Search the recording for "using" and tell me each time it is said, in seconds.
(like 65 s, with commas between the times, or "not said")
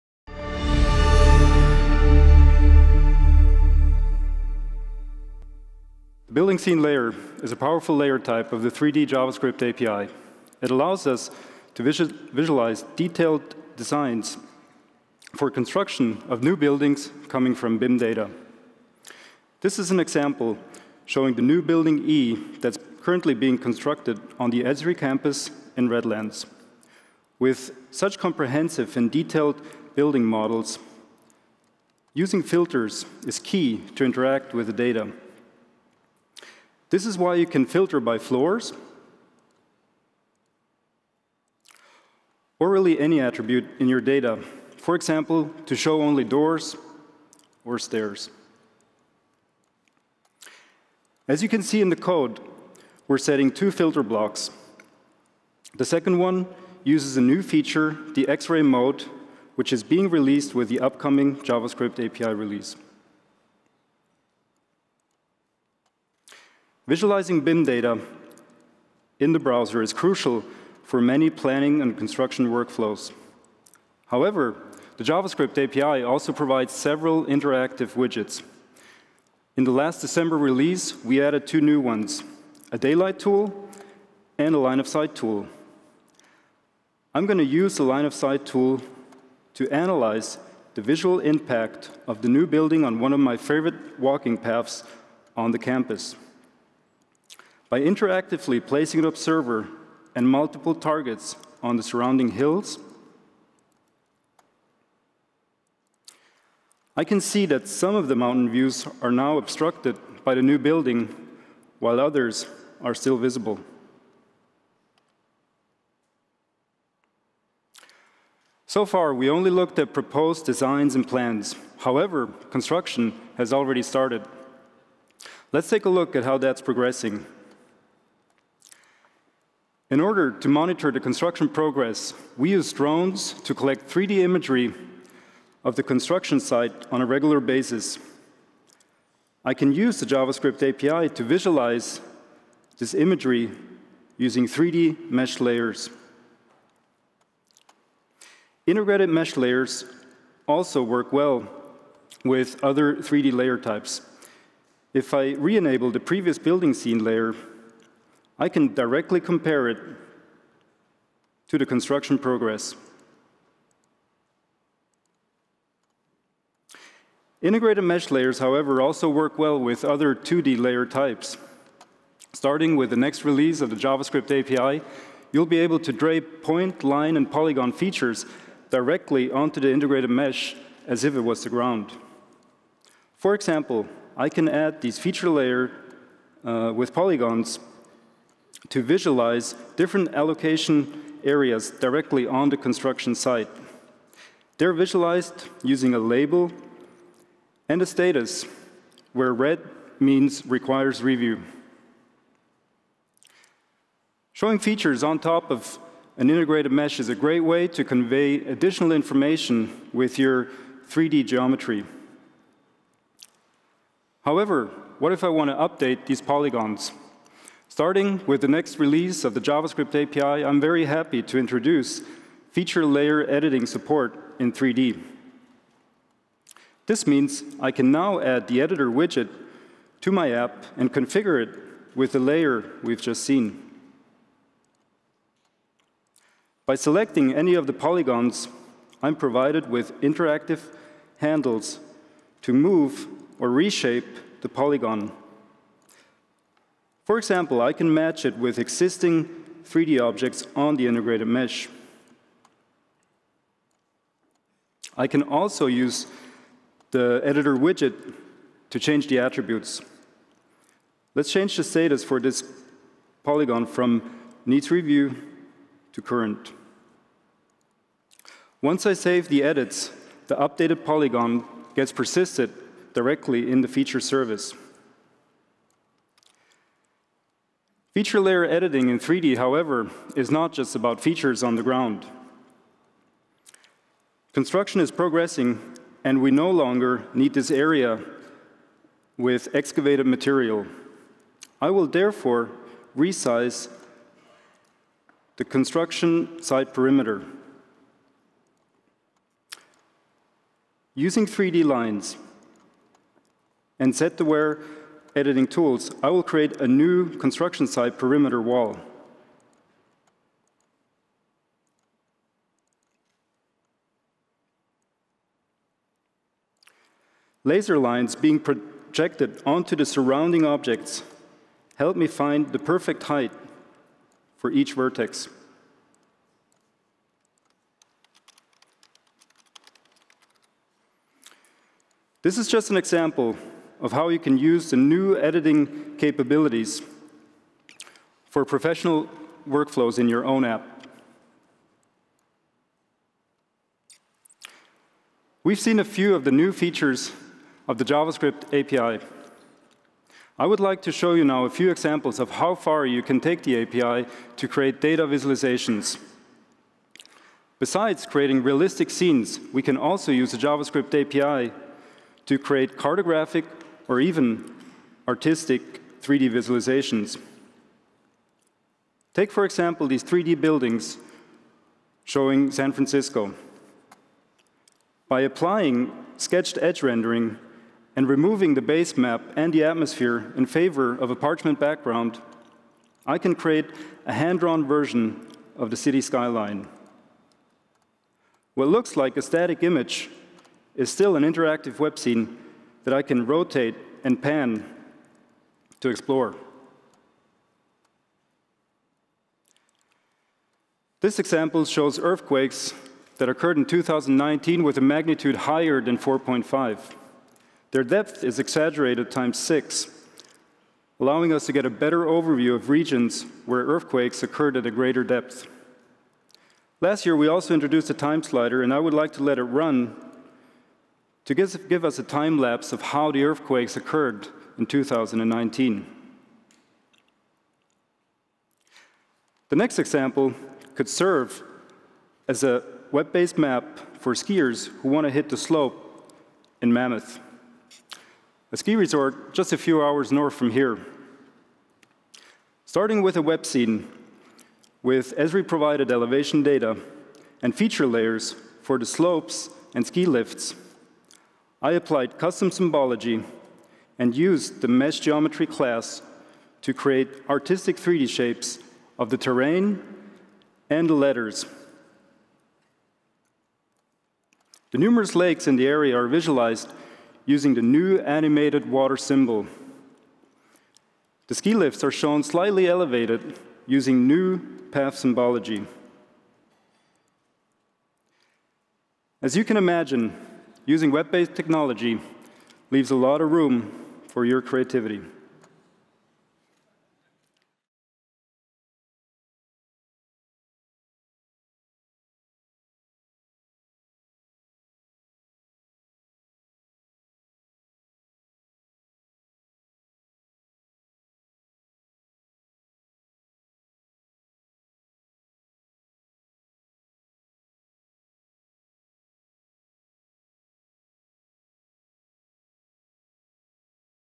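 32 s, 144 s, 195 s, 300 s, 467 s, 473 s, 480 s.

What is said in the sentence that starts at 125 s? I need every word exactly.
Let's take a look at how that's progressing.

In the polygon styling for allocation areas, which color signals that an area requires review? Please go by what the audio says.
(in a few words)
red.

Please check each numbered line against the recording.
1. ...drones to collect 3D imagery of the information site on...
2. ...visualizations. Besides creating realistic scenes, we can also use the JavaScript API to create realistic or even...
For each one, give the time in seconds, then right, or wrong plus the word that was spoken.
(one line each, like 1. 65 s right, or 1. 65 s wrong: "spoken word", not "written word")
1. 132 s wrong: "construction", not "information"
2. 355 s wrong: "cartographic", not "realistic".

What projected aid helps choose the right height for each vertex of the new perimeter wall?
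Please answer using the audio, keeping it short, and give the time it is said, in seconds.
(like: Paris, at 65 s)
Laser lines, at 317 s.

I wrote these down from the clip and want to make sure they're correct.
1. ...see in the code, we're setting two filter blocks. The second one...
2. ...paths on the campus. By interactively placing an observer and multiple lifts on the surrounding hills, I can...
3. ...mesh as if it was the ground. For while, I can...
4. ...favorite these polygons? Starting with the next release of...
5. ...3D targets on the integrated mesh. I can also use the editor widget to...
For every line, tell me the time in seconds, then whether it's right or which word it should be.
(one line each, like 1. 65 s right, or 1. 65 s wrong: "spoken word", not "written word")
1. 51 s right
2. 94 s wrong: "targets", not "lifts"
3. 180 s wrong: "example", not "while"
4. 215 s wrong: "update", not "favorite"
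5. 249 s wrong: "objects", not "targets".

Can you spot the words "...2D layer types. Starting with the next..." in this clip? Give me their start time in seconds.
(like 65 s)
170 s.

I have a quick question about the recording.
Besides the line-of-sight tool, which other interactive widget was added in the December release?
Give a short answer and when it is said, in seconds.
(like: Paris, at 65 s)
daylight tool, at 82 s.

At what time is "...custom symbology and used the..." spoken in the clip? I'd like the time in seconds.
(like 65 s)
452 s.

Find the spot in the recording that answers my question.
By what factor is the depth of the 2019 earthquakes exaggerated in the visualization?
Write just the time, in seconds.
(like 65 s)
409 s.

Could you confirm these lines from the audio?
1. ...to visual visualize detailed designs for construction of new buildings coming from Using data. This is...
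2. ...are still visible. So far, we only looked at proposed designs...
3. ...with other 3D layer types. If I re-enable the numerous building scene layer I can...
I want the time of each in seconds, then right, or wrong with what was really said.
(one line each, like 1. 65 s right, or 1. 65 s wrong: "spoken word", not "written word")
1. 11 s wrong: "BIM", not "Using"
2. 112 s right
3. 152 s wrong: "previous", not "numerous".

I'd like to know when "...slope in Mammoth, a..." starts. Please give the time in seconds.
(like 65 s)
435 s.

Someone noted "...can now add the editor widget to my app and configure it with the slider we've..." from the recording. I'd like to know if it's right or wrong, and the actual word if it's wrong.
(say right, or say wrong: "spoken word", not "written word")
wrong: "layer", not "slider".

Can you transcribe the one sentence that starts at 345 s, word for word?
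We've seen a few of the new features of the JavaScript API.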